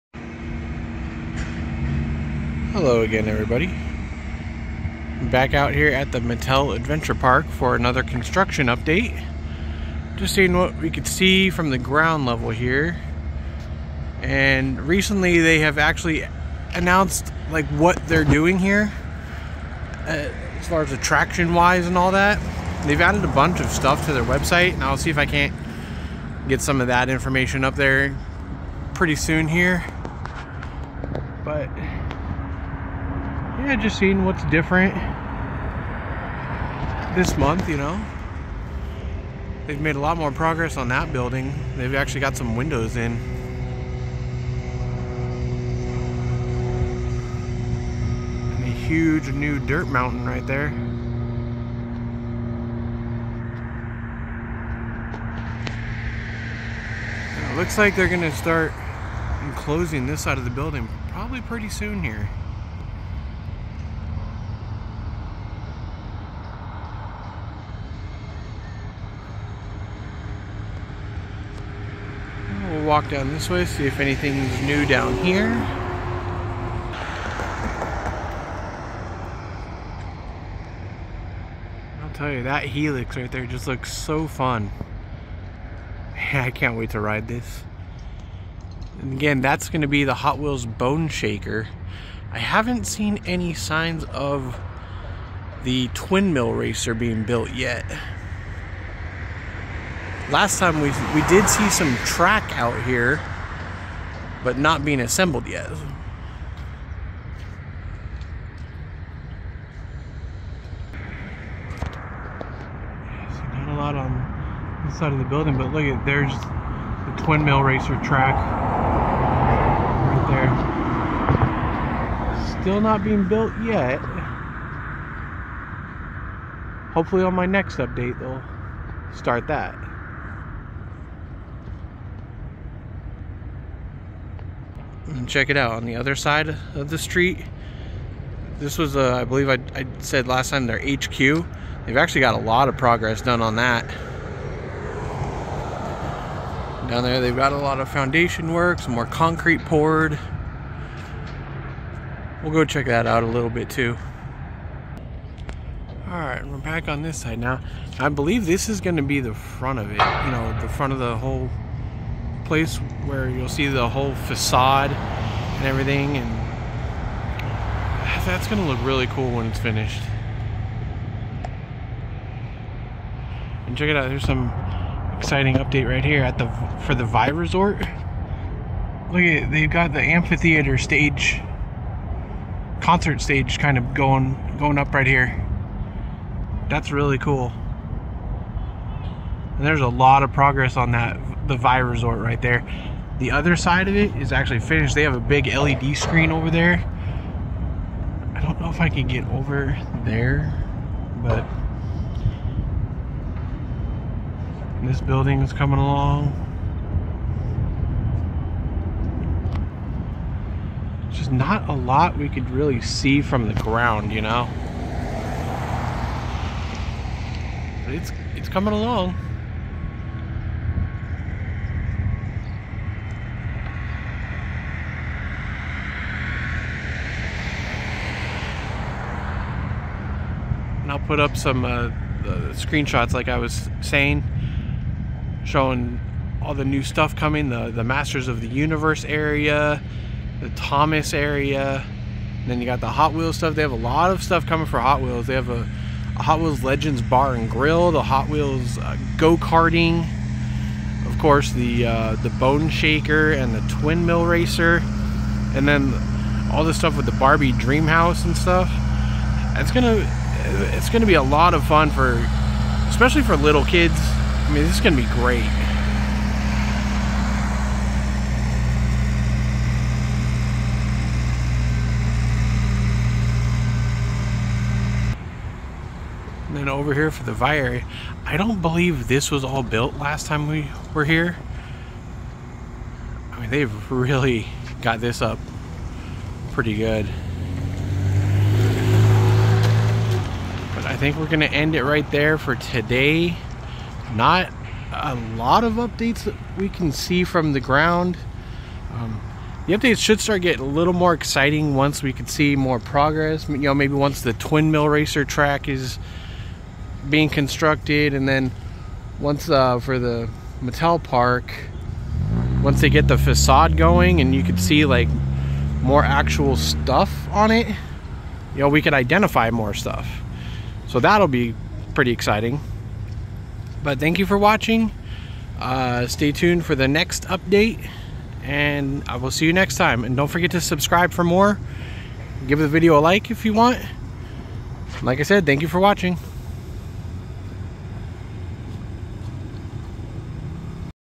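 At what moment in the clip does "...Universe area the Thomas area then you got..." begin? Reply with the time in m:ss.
3:58.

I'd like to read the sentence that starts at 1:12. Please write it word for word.
walk down this way, see if anything's new down here.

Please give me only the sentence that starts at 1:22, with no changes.
I'll tell you, that helix right there just looks so fun.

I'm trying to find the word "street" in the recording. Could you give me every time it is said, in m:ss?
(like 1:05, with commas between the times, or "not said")
2:16.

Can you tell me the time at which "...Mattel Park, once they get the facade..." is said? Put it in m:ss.
5:10.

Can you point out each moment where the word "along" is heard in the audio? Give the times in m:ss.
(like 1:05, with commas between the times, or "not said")
3:25, 3:38.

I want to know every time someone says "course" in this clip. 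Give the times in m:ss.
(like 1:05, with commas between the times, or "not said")
4:11.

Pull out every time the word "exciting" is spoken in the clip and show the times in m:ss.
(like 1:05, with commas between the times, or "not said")
2:55, 5:01, 5:22.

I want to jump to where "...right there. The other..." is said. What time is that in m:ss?
3:12.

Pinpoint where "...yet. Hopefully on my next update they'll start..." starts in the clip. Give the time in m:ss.
2:03.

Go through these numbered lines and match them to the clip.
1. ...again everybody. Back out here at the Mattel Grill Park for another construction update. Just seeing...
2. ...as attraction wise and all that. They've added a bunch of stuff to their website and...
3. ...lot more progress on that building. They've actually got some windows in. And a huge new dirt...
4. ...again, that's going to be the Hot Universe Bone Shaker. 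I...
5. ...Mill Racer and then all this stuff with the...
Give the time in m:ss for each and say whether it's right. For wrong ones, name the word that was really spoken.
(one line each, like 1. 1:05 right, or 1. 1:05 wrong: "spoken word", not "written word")
1. 0:03 wrong: "Adventure", not "Grill"
2. 0:20 right
3. 0:39 right
4. 1:29 wrong: "Wheels", not "Universe"
5. 4:14 right.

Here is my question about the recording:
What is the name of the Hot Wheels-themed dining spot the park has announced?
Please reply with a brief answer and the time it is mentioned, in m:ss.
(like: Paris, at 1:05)
Hot Wheels Legends Bar and Grill, at 4:06.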